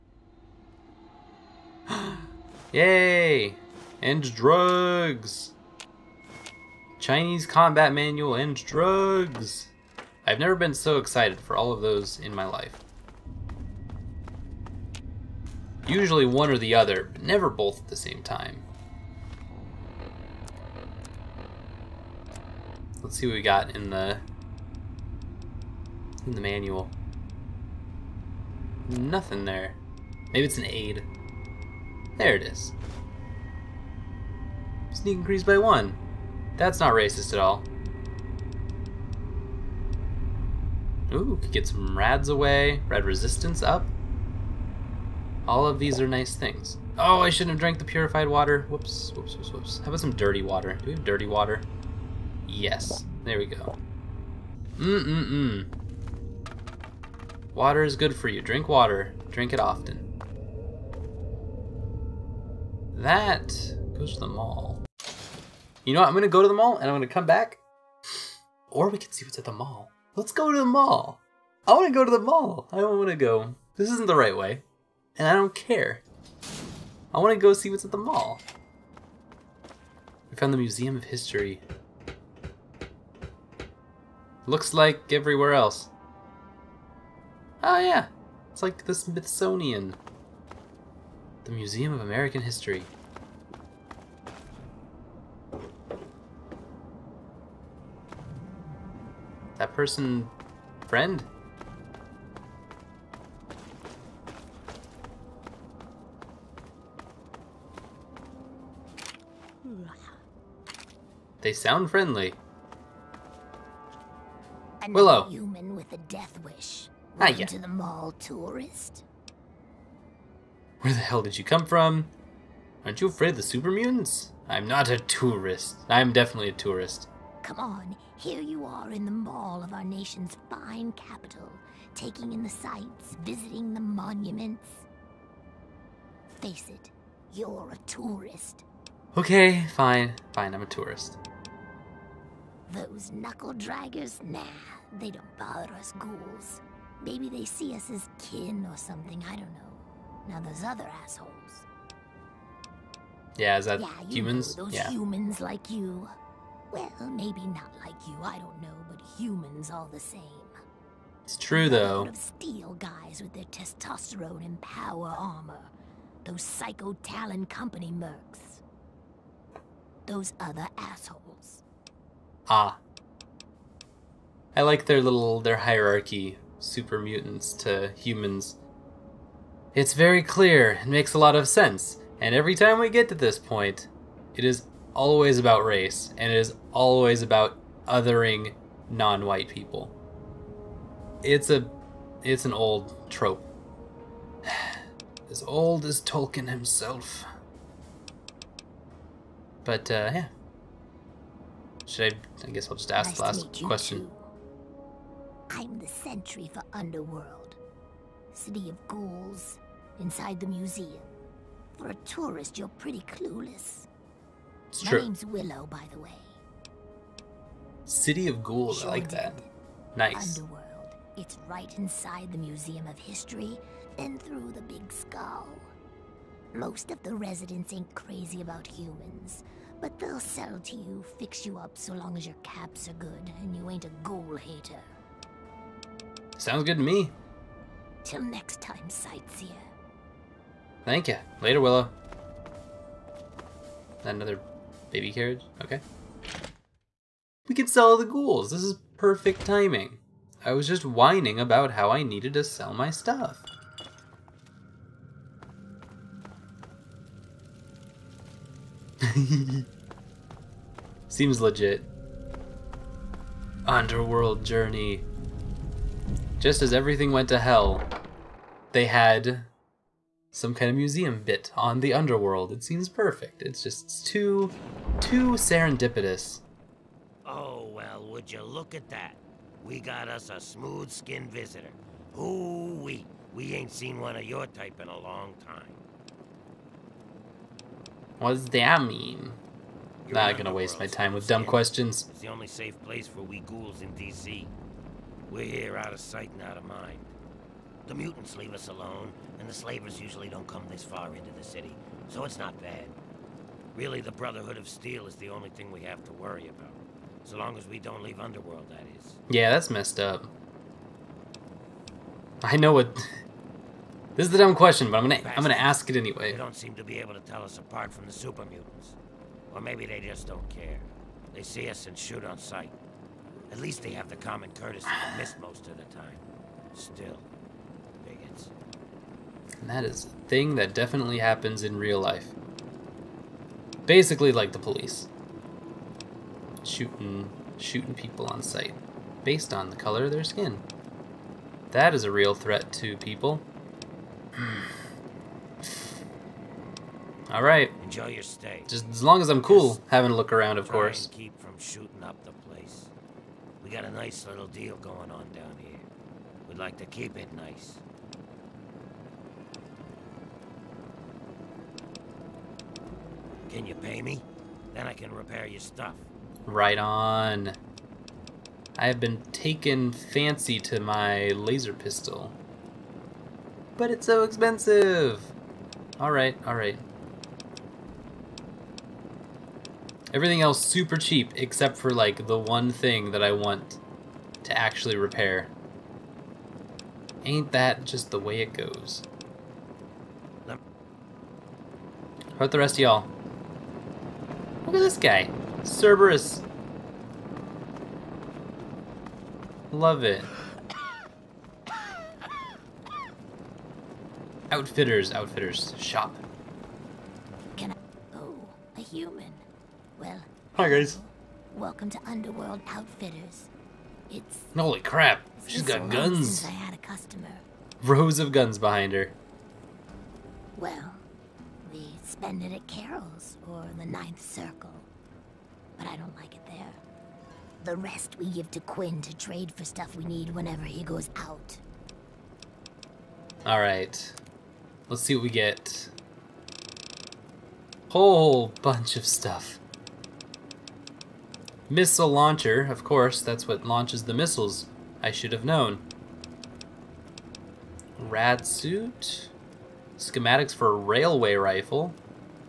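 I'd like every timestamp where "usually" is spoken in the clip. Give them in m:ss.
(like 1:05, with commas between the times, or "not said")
0:15, 4:59.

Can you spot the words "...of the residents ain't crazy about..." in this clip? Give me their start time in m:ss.
3:46.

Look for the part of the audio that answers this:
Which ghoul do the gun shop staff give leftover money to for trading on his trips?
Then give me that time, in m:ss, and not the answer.
7:08.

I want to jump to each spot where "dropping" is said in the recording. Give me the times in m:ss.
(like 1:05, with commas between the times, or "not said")
not said.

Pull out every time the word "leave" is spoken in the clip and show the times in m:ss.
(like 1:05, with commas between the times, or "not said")
4:58, 5:08.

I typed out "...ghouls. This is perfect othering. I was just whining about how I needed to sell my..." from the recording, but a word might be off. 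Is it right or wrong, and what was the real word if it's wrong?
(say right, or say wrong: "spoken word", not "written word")
wrong: "timing", not "othering".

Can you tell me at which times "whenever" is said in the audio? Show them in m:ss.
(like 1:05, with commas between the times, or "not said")
7:10.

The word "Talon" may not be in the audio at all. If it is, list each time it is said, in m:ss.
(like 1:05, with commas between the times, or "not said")
2:47.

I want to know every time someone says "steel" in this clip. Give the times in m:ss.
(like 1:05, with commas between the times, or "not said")
2:42, 5:04.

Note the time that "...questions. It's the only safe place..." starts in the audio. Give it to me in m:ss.
4:51.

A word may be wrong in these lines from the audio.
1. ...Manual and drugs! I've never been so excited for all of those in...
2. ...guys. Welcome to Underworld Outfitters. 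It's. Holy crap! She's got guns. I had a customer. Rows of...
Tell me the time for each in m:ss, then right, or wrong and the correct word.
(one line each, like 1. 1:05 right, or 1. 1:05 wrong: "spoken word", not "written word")
1. 0:07 right
2. 6:50 right.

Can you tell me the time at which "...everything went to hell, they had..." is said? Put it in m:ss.
4:26.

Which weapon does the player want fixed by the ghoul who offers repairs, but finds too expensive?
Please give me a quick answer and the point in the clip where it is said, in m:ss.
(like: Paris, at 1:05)
Laser pistol, at 6:11.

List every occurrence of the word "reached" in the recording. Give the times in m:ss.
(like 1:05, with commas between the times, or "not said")
not said.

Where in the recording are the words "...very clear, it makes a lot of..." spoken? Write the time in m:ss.
2:59.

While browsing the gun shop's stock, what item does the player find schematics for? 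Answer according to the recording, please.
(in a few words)
Railway rifle.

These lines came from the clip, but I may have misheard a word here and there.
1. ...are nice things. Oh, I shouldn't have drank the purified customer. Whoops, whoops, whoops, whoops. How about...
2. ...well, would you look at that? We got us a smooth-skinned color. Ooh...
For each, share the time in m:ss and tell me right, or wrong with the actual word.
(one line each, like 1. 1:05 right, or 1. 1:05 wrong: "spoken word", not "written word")
1. 0:45 wrong: "water", not "customer"
2. 4:37 wrong: "visitor", not "color".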